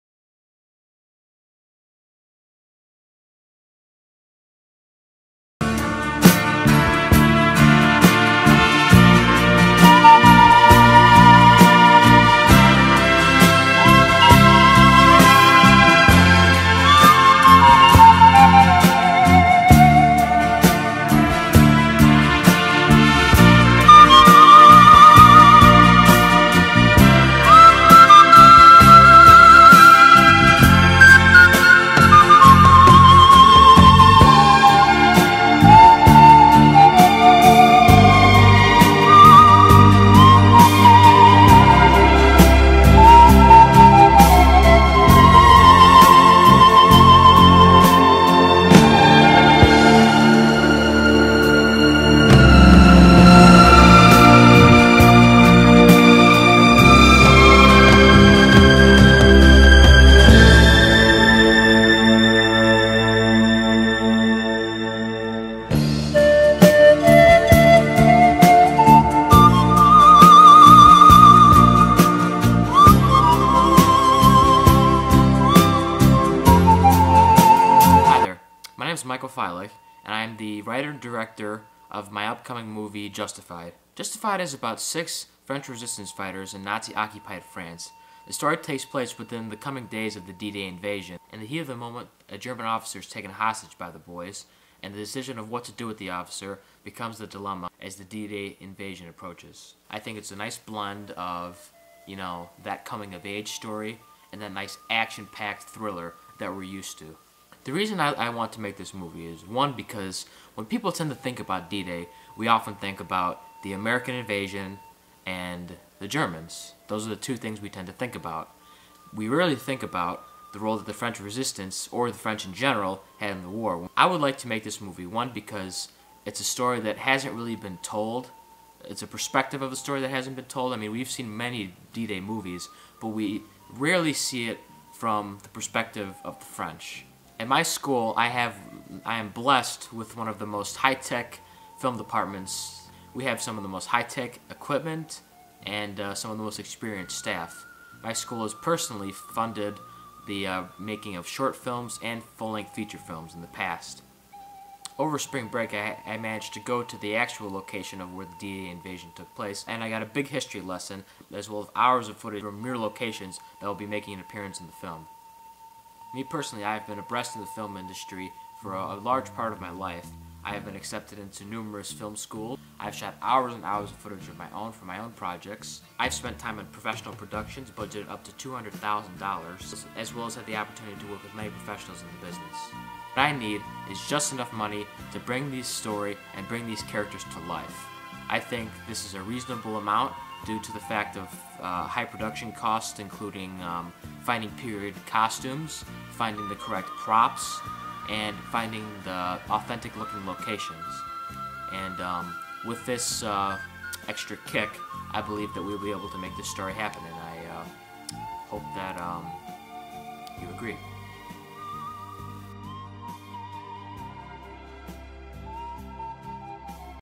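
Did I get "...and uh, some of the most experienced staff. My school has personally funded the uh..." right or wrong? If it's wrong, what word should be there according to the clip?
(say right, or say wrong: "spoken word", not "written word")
right.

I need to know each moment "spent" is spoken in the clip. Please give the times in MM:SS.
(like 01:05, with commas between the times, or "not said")
02:56.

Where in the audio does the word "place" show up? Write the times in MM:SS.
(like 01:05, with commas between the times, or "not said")
01:28, 02:39.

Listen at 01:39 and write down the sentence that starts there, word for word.
I think it's a nice blend of, you know, that coming-of-age story and that nice action-packed thriller that we're used to.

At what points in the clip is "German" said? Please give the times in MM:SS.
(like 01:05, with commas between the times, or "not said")
01:32, 01:56.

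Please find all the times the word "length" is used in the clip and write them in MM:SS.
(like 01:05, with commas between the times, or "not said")
02:32.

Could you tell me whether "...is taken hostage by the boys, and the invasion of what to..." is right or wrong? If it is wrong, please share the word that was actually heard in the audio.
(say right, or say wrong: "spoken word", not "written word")
wrong: "decision", not "invasion".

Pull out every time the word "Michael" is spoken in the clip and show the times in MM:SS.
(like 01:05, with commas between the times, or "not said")
01:19.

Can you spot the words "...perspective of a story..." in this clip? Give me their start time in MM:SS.
02:09.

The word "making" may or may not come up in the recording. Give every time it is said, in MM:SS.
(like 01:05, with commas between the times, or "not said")
02:30, 02:43.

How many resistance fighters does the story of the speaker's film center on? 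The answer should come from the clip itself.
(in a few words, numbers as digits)
6.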